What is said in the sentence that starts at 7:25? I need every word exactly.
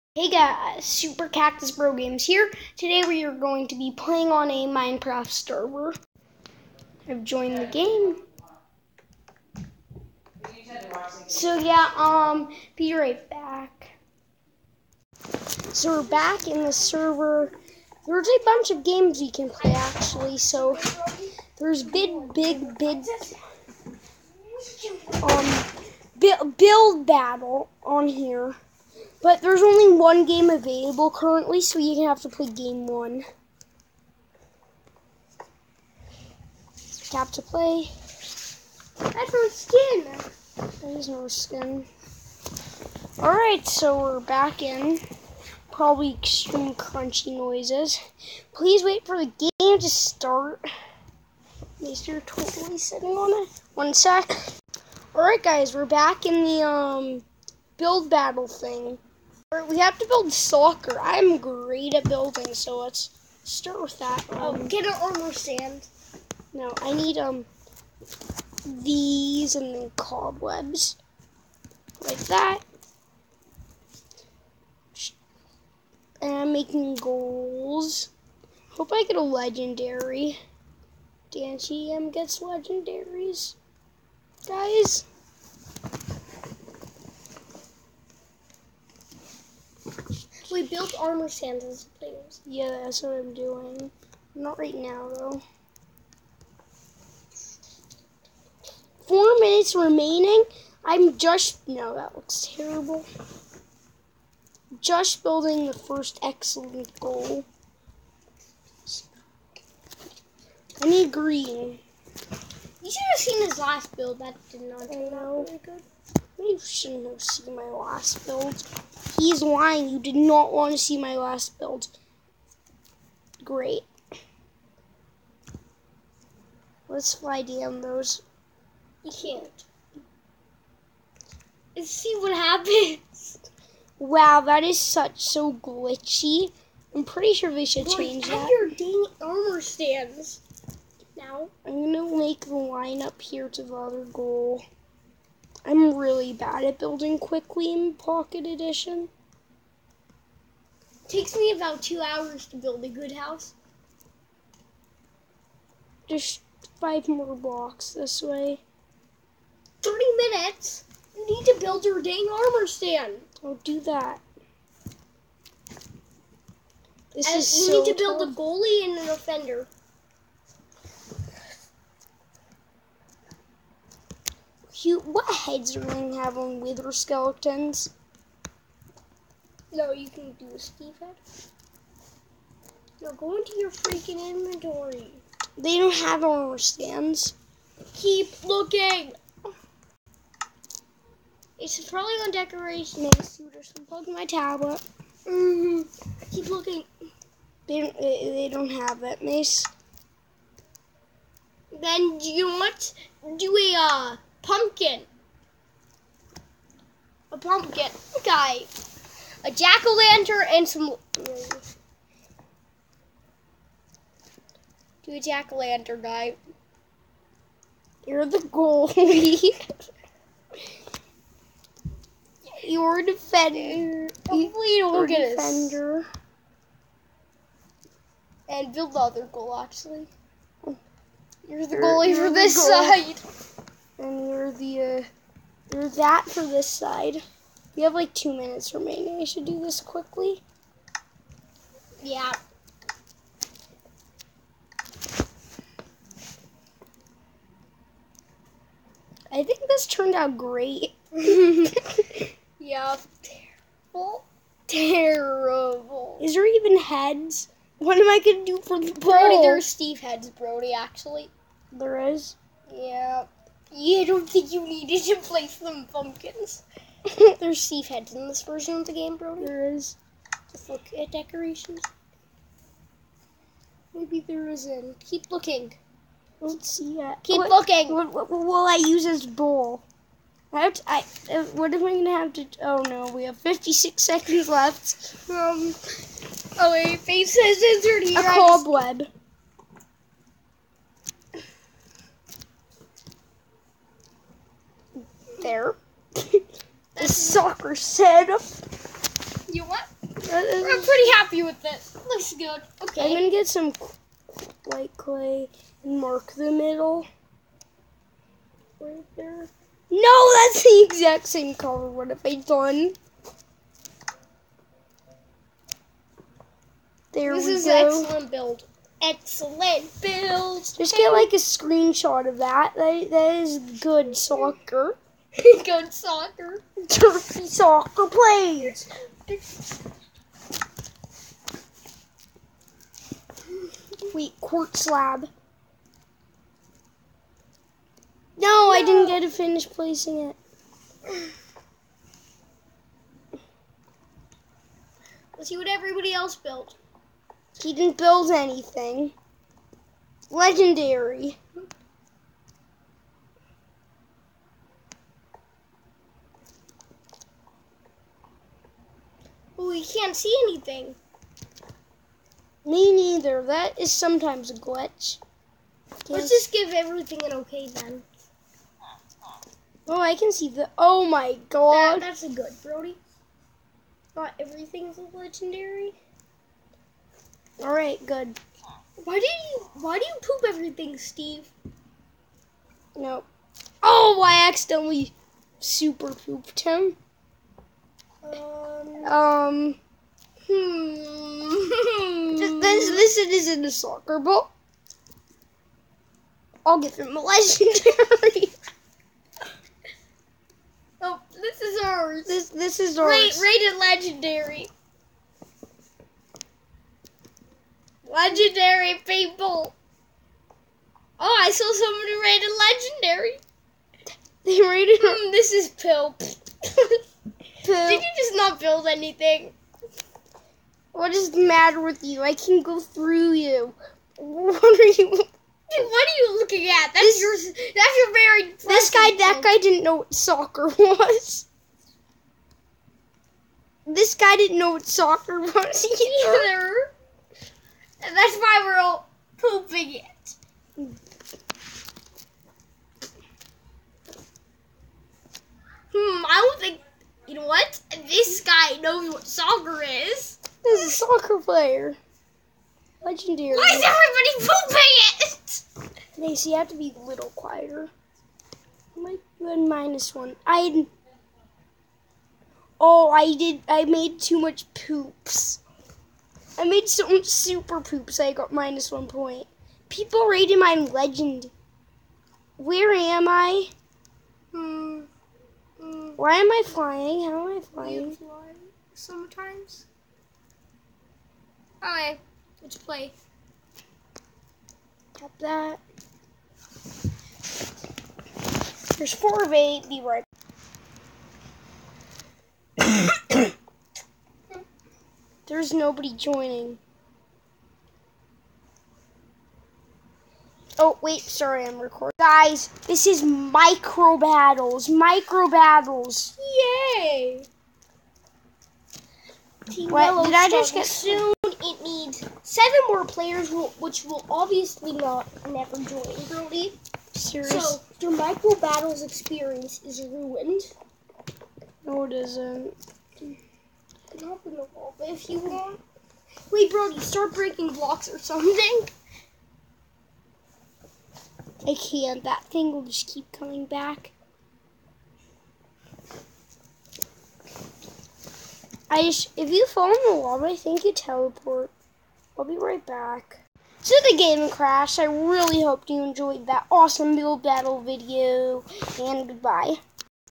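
Hmm, I don't think you know what?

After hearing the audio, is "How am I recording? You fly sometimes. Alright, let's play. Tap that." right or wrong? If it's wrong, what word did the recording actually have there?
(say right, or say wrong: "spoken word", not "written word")
wrong: "flying", not "recording".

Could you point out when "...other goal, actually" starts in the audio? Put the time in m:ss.
3:48.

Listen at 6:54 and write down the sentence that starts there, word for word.
They rated Mm, this is Pill.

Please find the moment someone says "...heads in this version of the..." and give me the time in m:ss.
4:27.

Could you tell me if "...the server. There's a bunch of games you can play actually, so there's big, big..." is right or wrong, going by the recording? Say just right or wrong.
right.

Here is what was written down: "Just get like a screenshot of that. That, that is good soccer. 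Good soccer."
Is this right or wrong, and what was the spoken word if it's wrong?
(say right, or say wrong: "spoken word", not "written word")
right.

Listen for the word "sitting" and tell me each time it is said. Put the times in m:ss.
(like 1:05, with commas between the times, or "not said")
0:52.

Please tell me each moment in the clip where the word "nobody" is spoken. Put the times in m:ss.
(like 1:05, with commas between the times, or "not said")
8:15.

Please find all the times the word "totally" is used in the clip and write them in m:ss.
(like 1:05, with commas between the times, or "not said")
0:52.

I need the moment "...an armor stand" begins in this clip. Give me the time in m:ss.
1:04.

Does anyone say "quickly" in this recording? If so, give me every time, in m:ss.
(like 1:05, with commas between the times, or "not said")
2:27, 3:59.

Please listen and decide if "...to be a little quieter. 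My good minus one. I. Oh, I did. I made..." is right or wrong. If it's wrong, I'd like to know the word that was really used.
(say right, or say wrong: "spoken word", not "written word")
right.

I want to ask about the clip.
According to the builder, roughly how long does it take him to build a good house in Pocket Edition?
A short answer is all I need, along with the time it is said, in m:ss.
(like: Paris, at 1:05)
About two hours, at 2:31.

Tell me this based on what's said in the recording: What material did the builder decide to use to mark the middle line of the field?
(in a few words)
White clay.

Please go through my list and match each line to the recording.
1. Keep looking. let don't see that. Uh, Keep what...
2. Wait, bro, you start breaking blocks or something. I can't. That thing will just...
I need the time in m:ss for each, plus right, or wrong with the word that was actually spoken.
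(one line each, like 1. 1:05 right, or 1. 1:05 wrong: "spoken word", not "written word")
1. 4:34 right
2. 8:46 right.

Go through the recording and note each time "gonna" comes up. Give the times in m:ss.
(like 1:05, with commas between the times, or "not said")
2:21, 4:18, 4:41, 5:03.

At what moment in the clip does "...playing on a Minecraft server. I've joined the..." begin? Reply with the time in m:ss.
0:03.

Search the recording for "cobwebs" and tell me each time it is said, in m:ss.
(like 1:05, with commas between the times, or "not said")
1:09, 4:48.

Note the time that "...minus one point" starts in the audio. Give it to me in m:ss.
7:48.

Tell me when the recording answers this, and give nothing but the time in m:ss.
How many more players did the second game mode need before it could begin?
8:32.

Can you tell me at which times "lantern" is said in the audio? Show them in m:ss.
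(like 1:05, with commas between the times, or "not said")
3:29, 3:35.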